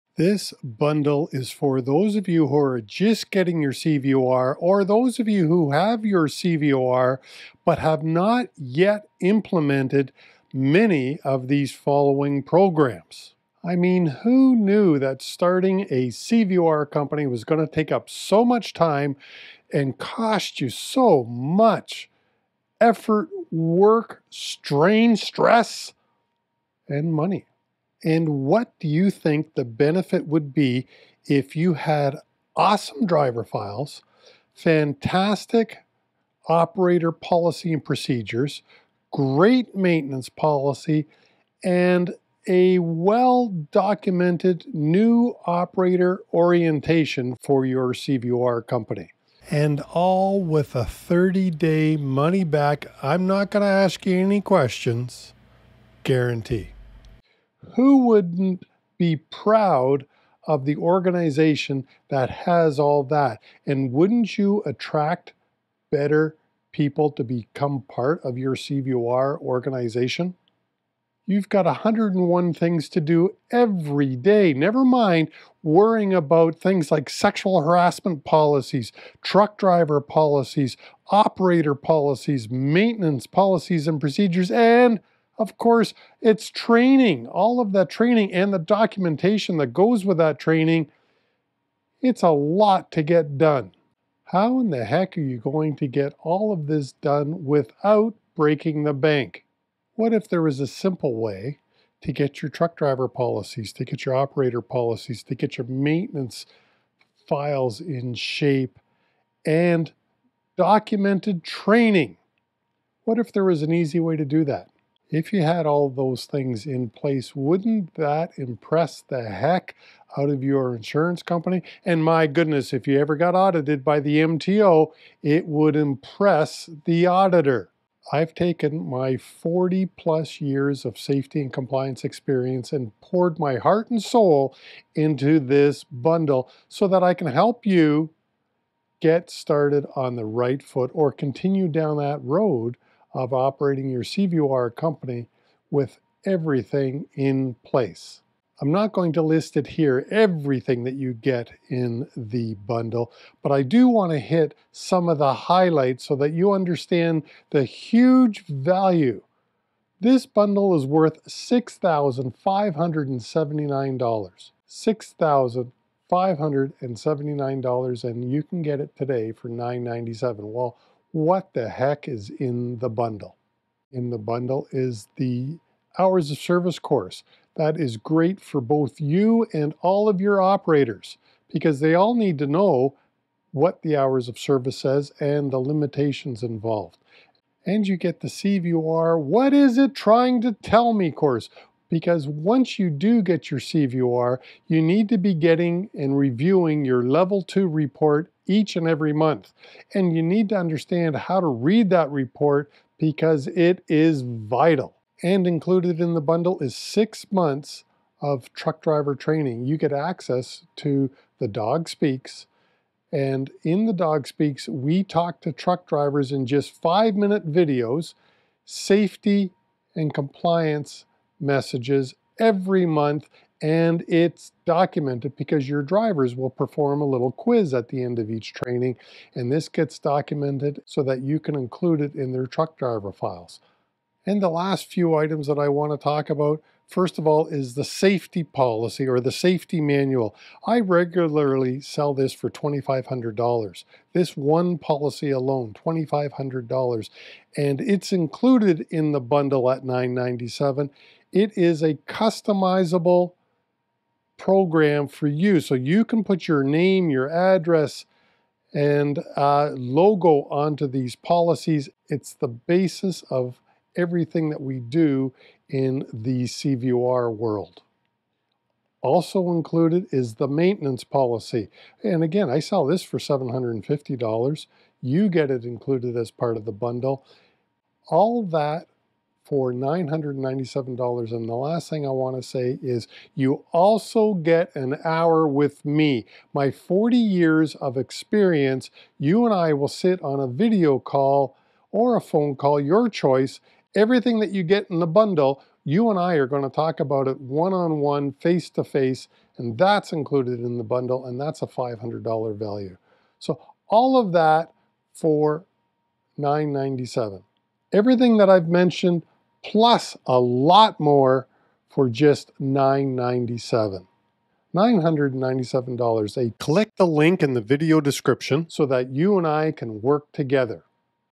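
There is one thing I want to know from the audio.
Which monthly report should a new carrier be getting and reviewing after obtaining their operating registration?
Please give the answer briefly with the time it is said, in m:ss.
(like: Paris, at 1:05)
Level two report, at 3:17.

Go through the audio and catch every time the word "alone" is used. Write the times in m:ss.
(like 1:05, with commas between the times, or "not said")
4:05.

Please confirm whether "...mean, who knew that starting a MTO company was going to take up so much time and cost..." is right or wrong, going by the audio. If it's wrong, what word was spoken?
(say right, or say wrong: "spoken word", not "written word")
wrong: "CVOR", not "MTO".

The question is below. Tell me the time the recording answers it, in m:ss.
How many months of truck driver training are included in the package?
3:26.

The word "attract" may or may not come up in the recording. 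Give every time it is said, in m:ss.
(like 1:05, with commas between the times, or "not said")
1:04.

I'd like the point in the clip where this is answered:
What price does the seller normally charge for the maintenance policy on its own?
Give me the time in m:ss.
4:33.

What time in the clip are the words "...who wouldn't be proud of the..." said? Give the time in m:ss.
0:57.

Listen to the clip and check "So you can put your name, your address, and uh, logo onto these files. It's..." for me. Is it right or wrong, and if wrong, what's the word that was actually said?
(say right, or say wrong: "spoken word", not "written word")
wrong: "policies", not "files".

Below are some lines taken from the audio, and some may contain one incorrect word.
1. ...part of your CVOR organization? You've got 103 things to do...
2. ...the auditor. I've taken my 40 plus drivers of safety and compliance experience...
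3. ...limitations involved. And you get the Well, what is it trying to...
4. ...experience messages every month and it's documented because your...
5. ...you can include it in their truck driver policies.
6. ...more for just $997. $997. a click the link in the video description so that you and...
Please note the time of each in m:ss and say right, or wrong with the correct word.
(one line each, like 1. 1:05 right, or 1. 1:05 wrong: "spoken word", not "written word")
1. 1:07 wrong: "101", not "103"
2. 2:06 wrong: "years", not "drivers"
3. 3:05 wrong: "CVOR", not "Well"
4. 3:40 wrong: "compliance", not "experience"
5. 3:51 wrong: "files", not "policies"
6. 5:10 right.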